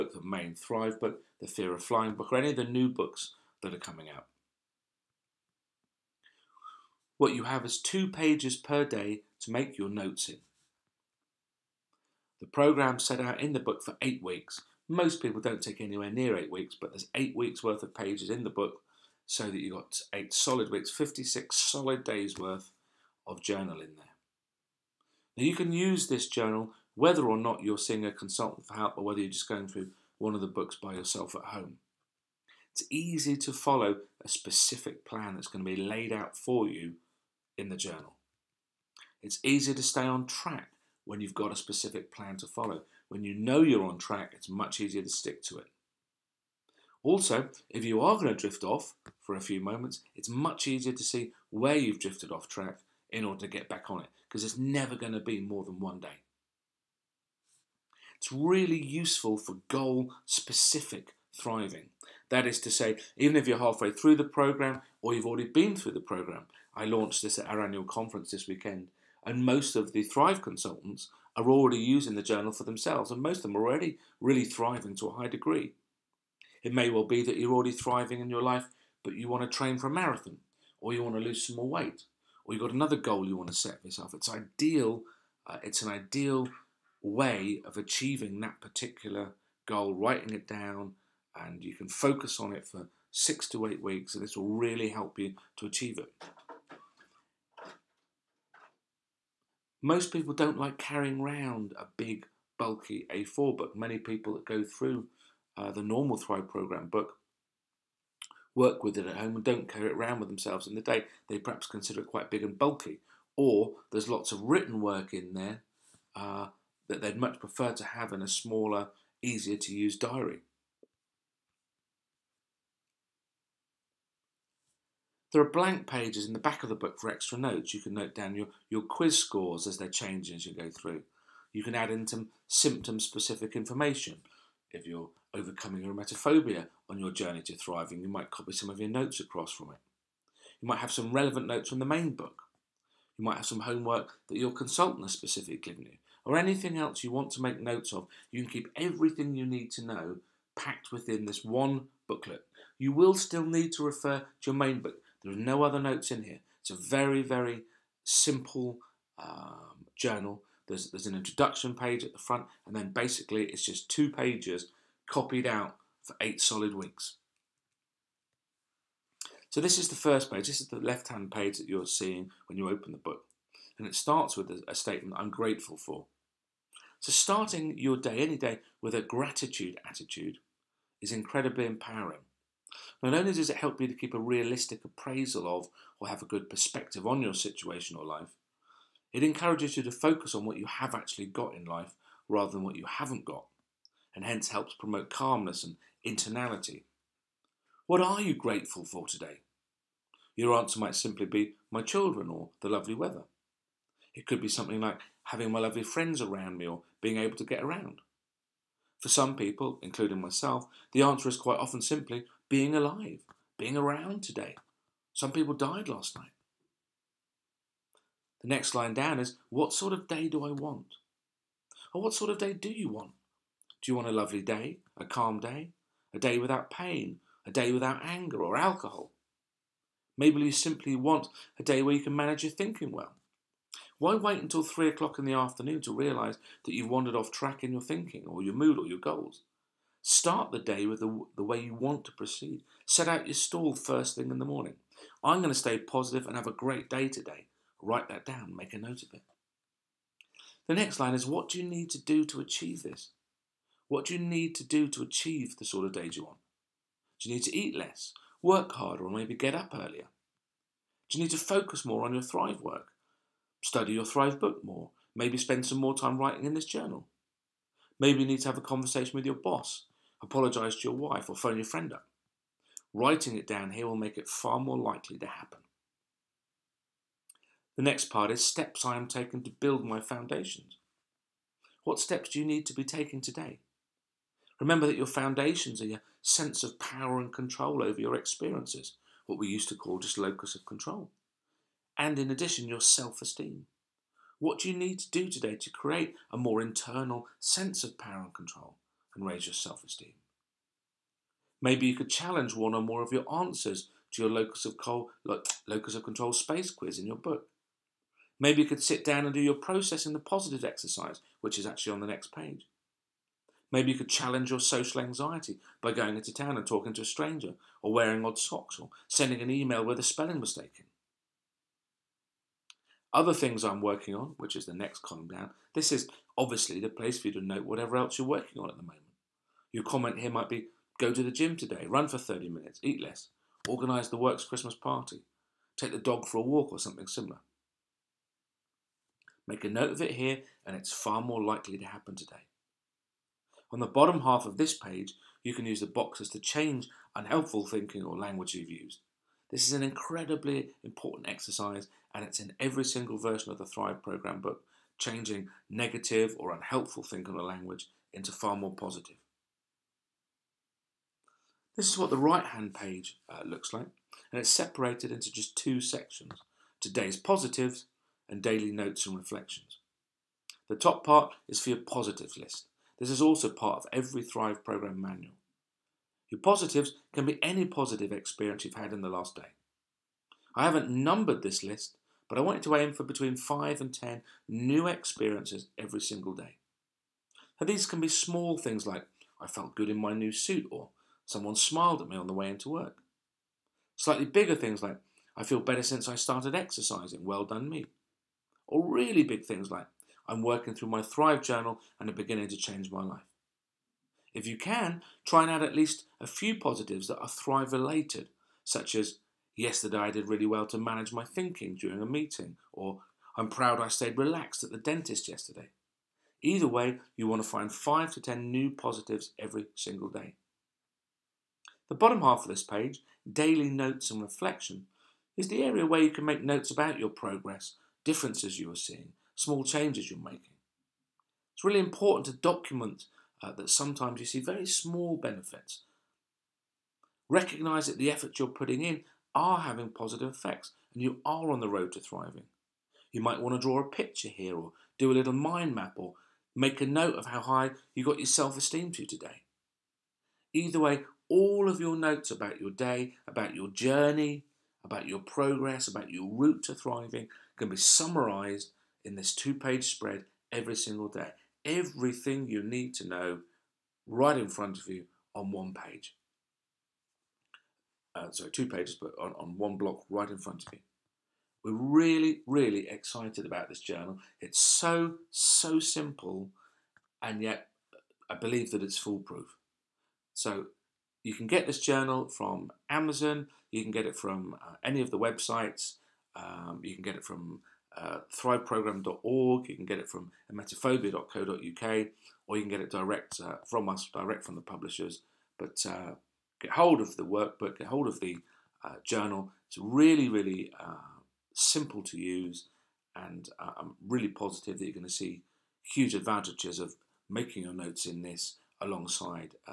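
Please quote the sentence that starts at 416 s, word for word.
Either way, you want to find 5 to 10 new positives every single day.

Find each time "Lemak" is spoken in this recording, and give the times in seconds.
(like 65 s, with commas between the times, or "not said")
not said.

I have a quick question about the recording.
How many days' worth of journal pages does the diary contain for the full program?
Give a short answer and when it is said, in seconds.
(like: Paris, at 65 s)
56, at 20 s.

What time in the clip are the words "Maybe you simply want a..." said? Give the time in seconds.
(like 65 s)
230 s.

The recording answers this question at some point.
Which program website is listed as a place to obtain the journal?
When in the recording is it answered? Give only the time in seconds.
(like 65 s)
488 s.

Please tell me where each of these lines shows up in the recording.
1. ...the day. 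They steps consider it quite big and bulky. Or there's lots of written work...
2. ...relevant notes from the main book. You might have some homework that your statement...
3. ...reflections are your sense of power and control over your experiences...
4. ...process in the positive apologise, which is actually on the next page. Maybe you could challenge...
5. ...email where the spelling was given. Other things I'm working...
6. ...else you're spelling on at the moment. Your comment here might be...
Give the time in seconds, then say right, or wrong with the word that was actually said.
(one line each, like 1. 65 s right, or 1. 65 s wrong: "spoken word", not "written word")
1. 110 s wrong: "perhaps", not "steps"
2. 141 s wrong: "consultant", not "statement"
3. 285 s wrong: "foundations", not "reflections"
4. 309 s wrong: "exercise", not "apologise"
5. 319 s wrong: "taken", not "given"
6. 327 s wrong: "working", not "spelling".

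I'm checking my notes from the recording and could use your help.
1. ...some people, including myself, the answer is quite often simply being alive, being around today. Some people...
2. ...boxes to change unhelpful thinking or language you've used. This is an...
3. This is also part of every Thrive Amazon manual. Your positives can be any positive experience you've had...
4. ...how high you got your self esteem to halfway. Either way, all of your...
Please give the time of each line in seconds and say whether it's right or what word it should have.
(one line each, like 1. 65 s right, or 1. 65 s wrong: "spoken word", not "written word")
1. 209 s right
2. 345 s right
3. 373 s wrong: "Program", not "Amazon"
4. 447 s wrong: "today", not "halfway".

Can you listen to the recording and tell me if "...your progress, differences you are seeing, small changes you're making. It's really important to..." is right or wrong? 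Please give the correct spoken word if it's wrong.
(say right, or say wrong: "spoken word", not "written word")
right.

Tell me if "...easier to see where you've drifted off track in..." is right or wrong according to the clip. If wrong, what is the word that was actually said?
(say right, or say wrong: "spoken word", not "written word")
right.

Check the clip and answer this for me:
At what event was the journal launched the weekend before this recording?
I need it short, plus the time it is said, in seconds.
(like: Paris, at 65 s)
annual conference, at 67 s.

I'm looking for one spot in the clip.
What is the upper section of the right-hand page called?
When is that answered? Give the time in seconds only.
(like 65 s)
366 s.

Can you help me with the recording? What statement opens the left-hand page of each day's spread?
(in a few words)
I'm grateful for.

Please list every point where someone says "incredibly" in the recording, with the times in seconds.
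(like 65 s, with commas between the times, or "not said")
181 s, 349 s.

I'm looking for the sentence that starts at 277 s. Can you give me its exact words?
The next part is steps I am taking to build my foundations.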